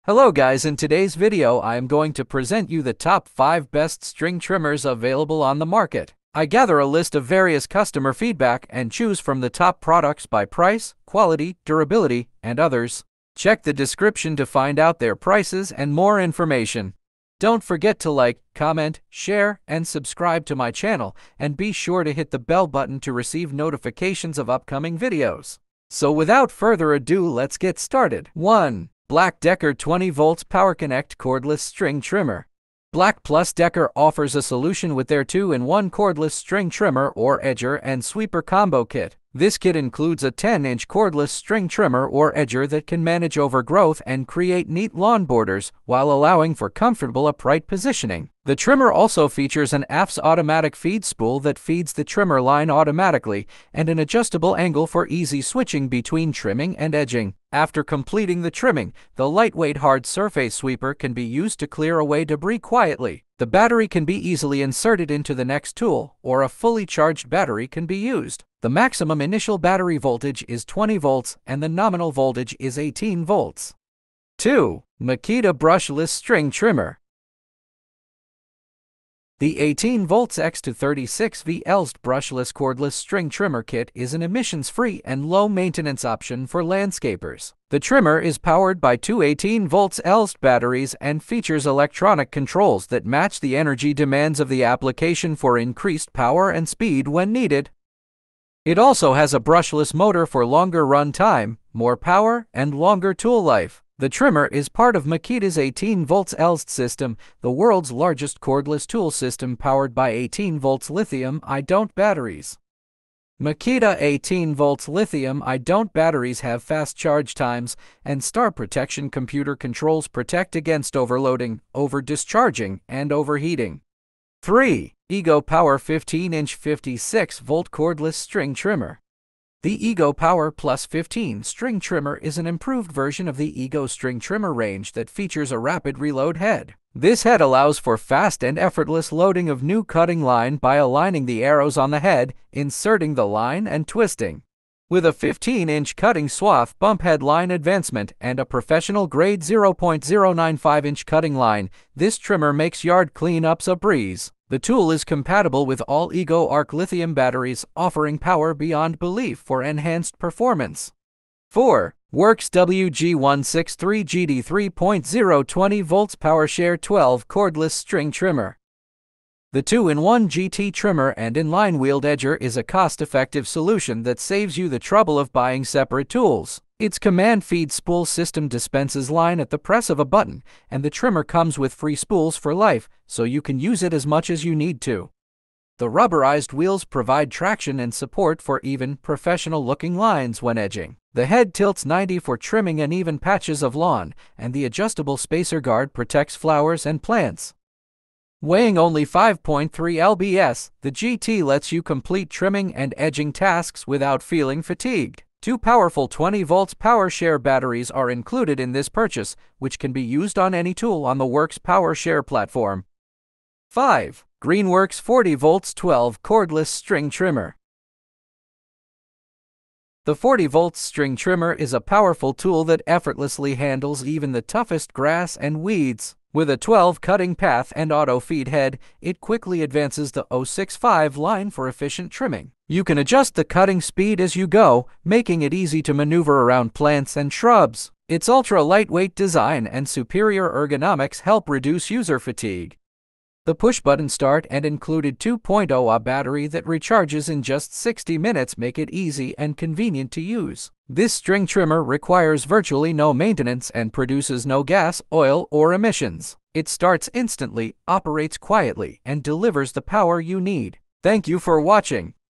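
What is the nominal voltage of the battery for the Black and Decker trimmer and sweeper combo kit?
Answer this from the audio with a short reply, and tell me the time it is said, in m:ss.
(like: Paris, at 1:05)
18 volts, at 1:11.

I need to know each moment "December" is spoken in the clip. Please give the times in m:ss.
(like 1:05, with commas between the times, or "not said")
not said.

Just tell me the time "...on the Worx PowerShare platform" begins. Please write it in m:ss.
3:31.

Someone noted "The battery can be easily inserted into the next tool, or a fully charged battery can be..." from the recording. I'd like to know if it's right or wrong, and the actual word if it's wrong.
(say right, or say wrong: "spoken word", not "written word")
right.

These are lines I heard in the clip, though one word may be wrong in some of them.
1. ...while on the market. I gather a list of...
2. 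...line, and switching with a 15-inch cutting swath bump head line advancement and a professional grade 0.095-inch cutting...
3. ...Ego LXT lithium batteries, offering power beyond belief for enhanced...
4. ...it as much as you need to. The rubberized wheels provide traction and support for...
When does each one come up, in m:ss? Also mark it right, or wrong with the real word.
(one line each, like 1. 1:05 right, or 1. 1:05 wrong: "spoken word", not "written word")
1. 0:04 wrong: "available", not "while"
2. 2:23 wrong: "twisting", not "switching"
3. 2:36 wrong: "Arc", not "LXT"
4. 3:03 right.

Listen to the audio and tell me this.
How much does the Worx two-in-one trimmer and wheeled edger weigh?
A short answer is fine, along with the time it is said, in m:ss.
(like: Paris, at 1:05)
5.3 lbs, at 3:19.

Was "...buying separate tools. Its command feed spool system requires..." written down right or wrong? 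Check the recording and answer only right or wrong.
wrong.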